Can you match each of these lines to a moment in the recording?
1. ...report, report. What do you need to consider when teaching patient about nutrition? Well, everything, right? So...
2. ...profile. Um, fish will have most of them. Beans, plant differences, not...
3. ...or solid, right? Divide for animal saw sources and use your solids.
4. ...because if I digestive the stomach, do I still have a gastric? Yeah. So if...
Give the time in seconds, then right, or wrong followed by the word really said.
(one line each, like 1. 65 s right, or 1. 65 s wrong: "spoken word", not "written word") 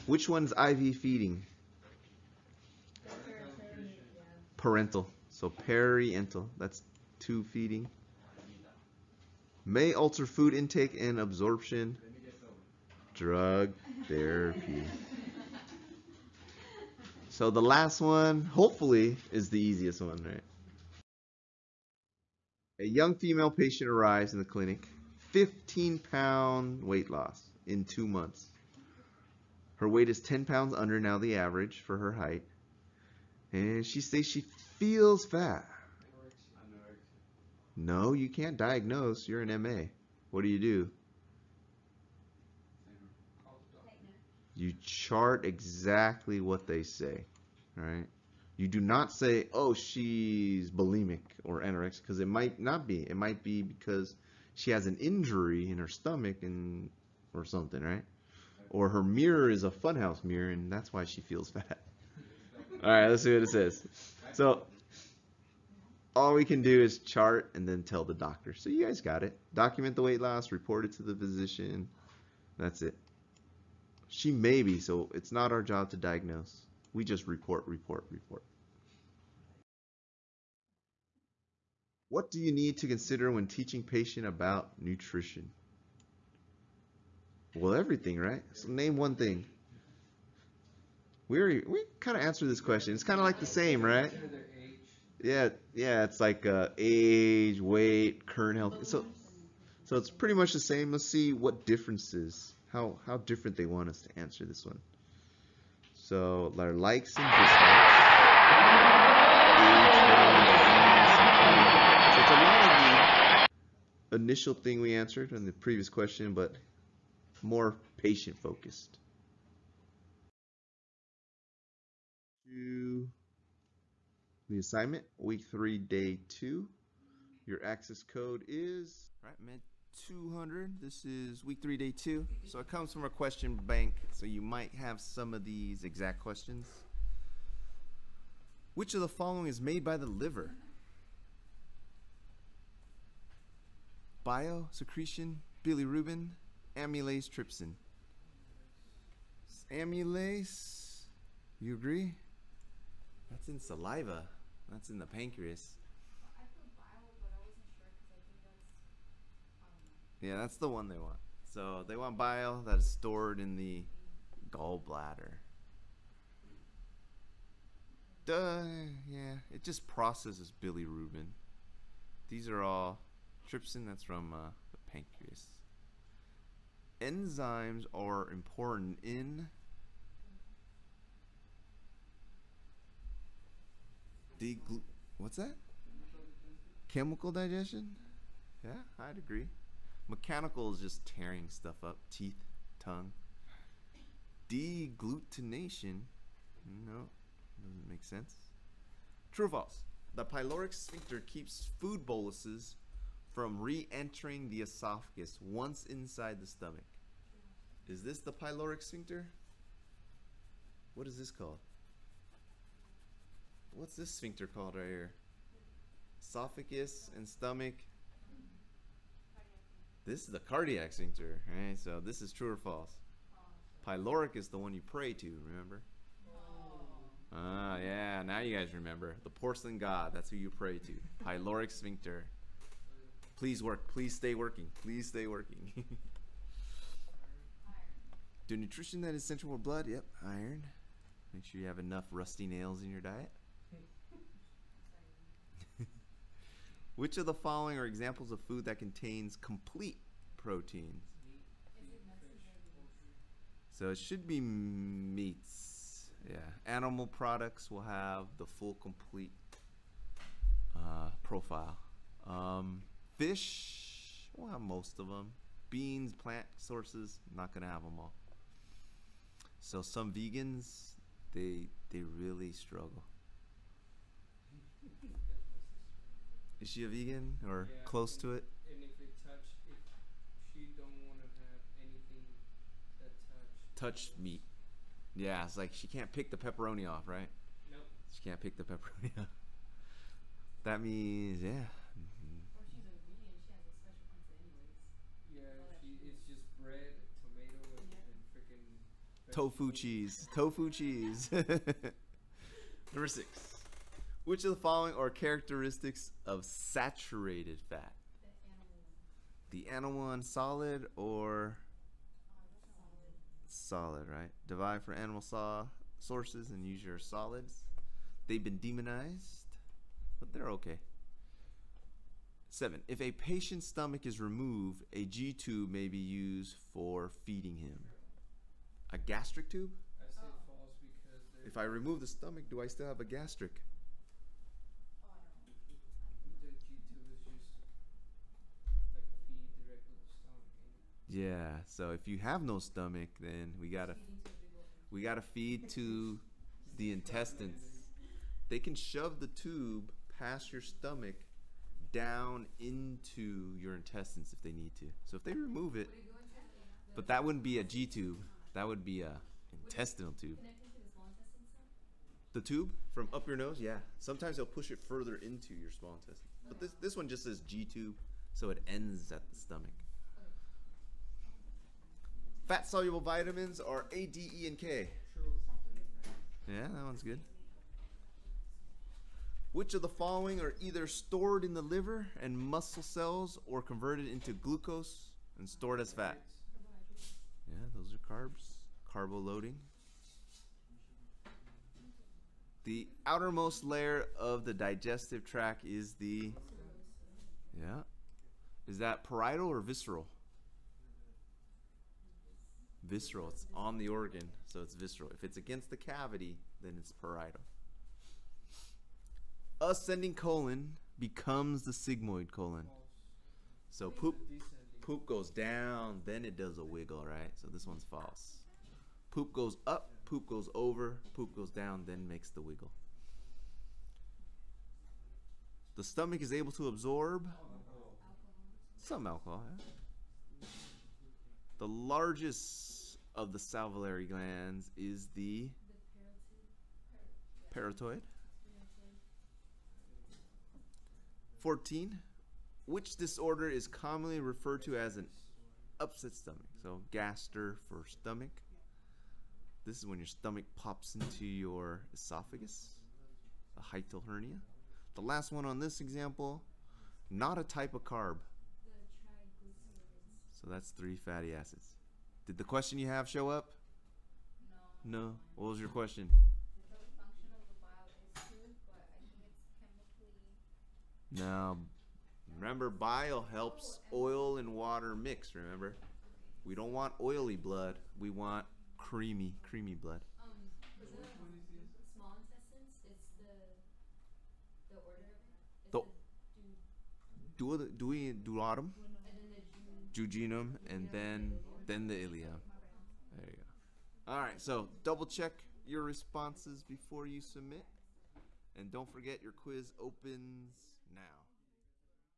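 1. 77 s right
2. 261 s wrong: "sources", not "differences"
3. 310 s right
4. 330 s wrong: "remove", not "digestive".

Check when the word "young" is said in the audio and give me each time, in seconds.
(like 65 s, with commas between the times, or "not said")
22 s.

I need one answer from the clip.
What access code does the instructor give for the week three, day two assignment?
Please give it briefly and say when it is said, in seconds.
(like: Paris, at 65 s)
med 200, at 129 s.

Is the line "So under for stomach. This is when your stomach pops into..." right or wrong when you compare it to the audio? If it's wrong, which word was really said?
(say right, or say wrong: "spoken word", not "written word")
wrong: "gaster", not "under".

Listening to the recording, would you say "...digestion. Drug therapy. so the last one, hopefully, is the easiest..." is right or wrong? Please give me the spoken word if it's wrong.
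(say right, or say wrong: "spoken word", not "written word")
wrong: "absorption", not "digestion".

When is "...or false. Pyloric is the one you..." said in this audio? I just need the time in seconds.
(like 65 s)
222 s.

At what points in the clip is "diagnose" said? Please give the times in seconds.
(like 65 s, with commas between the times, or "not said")
38 s, 75 s.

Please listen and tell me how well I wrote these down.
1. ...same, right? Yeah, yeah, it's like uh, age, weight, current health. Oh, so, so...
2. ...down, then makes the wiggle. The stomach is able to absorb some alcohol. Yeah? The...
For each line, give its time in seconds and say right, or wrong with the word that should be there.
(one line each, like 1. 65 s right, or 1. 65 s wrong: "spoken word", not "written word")
1. 93 s right
2. 421 s right.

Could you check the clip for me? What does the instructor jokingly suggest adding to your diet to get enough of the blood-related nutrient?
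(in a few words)
rusty nails.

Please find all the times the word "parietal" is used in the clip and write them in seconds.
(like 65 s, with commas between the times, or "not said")
399 s, 406 s.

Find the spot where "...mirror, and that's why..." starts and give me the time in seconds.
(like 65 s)
60 s.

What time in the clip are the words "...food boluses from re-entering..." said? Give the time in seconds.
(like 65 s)
201 s.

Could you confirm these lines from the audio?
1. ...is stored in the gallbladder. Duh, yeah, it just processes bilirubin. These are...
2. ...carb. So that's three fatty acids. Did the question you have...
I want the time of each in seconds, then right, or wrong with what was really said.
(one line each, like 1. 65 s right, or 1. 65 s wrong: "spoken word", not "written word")
1. 162 s right
2. 457 s right.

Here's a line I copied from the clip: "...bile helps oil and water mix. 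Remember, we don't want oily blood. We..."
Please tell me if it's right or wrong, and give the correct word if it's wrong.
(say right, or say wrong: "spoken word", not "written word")
right.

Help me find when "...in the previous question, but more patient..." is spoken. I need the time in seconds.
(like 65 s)
115 s.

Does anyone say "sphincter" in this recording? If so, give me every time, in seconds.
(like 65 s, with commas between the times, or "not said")
200 s, 208 s, 214 s, 220 s, 231 s.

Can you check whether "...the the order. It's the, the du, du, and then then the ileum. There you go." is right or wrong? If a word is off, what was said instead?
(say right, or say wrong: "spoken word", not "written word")
right.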